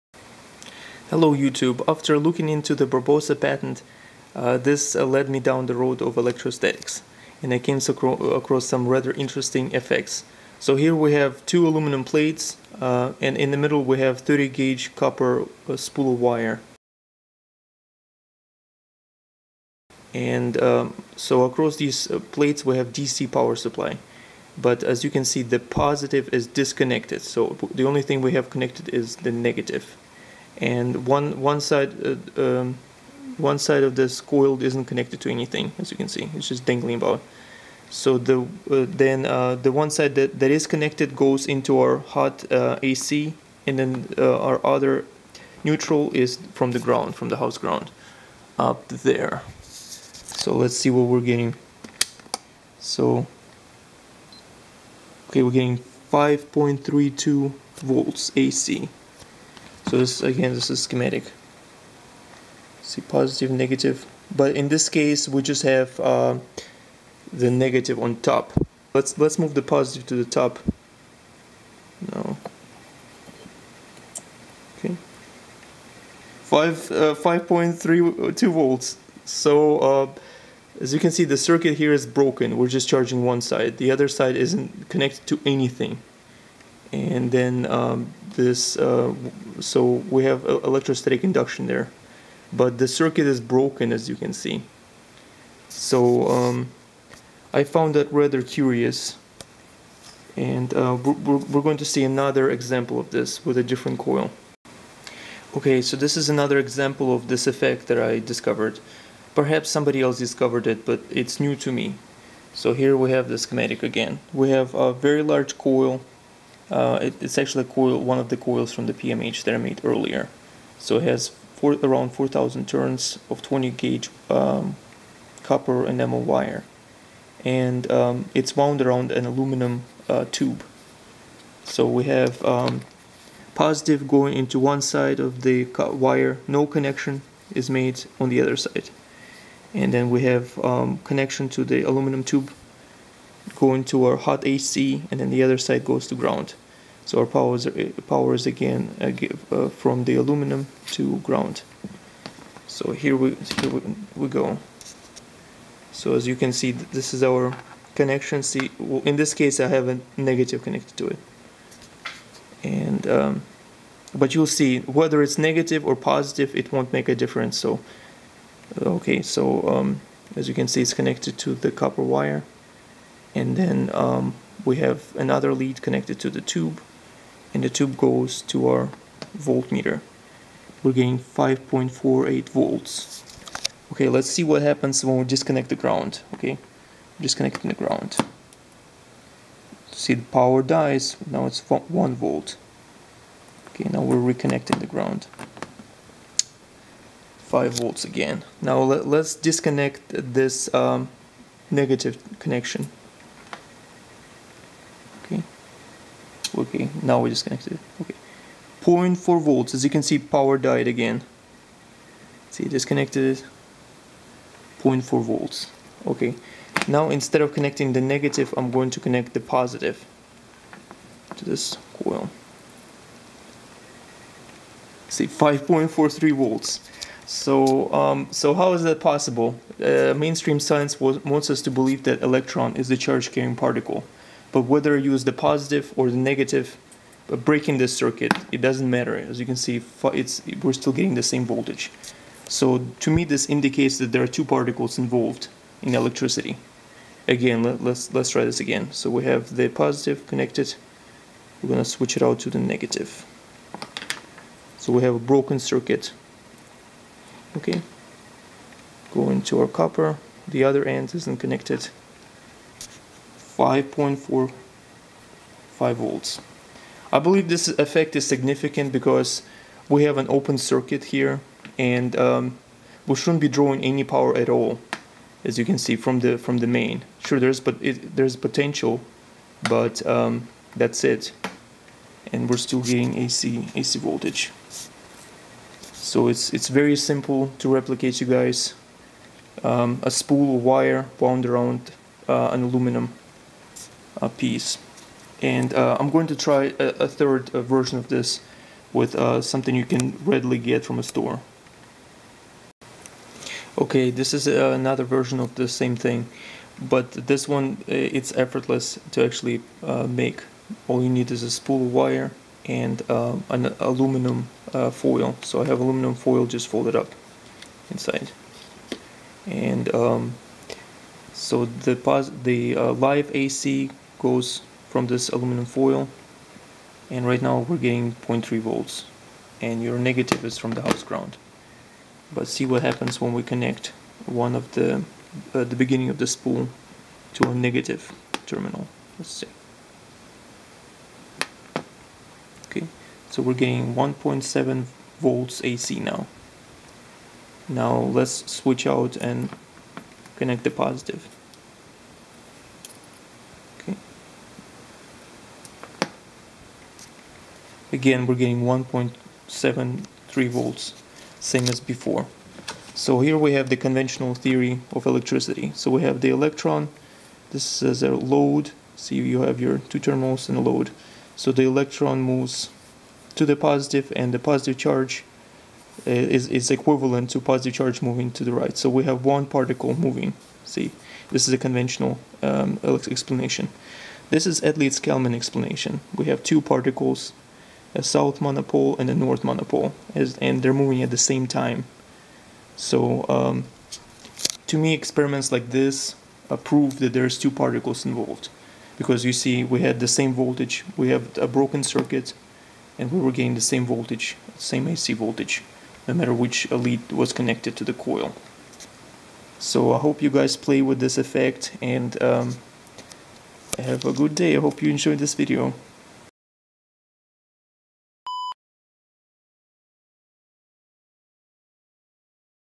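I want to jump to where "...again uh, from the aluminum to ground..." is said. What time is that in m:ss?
2:28.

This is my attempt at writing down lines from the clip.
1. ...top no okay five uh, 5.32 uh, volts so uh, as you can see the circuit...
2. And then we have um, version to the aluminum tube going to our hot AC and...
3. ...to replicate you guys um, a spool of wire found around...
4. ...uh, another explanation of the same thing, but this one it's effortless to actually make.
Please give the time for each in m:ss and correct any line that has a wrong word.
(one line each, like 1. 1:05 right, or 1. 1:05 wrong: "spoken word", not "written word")
1. 1:10 right
2. 2:19 wrong: "connection", not "version"
3. 4:47 wrong: "wound", not "found"
4. 5:04 wrong: "version", not "explanation".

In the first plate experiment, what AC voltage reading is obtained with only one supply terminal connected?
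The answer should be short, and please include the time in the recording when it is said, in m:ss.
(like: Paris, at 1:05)
5.32 volts, at 0:56.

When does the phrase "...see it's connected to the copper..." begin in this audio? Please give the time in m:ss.
2:50.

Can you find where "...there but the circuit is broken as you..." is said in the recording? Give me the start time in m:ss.
1:31.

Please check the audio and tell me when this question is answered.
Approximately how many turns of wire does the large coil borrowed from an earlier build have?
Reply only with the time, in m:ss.
2:02.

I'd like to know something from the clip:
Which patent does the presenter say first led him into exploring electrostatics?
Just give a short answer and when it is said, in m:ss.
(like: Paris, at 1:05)
Barbosa patent, at 0:02.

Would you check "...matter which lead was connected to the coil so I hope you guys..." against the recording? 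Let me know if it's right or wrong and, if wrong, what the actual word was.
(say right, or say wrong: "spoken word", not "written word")
right.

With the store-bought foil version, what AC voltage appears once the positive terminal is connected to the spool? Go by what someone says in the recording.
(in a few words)
1.73 volts.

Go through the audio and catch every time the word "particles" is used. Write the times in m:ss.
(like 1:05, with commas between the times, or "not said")
3:53, 4:04, 6:19, 6:26, 6:37.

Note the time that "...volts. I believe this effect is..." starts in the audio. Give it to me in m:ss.
4:25.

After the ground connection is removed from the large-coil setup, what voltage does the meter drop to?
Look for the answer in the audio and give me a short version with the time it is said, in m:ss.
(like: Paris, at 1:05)
1 volt, at 3:11.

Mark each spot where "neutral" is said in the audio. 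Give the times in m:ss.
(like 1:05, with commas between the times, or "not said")
0:45.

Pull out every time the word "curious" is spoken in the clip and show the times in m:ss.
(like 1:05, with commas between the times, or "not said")
1:38.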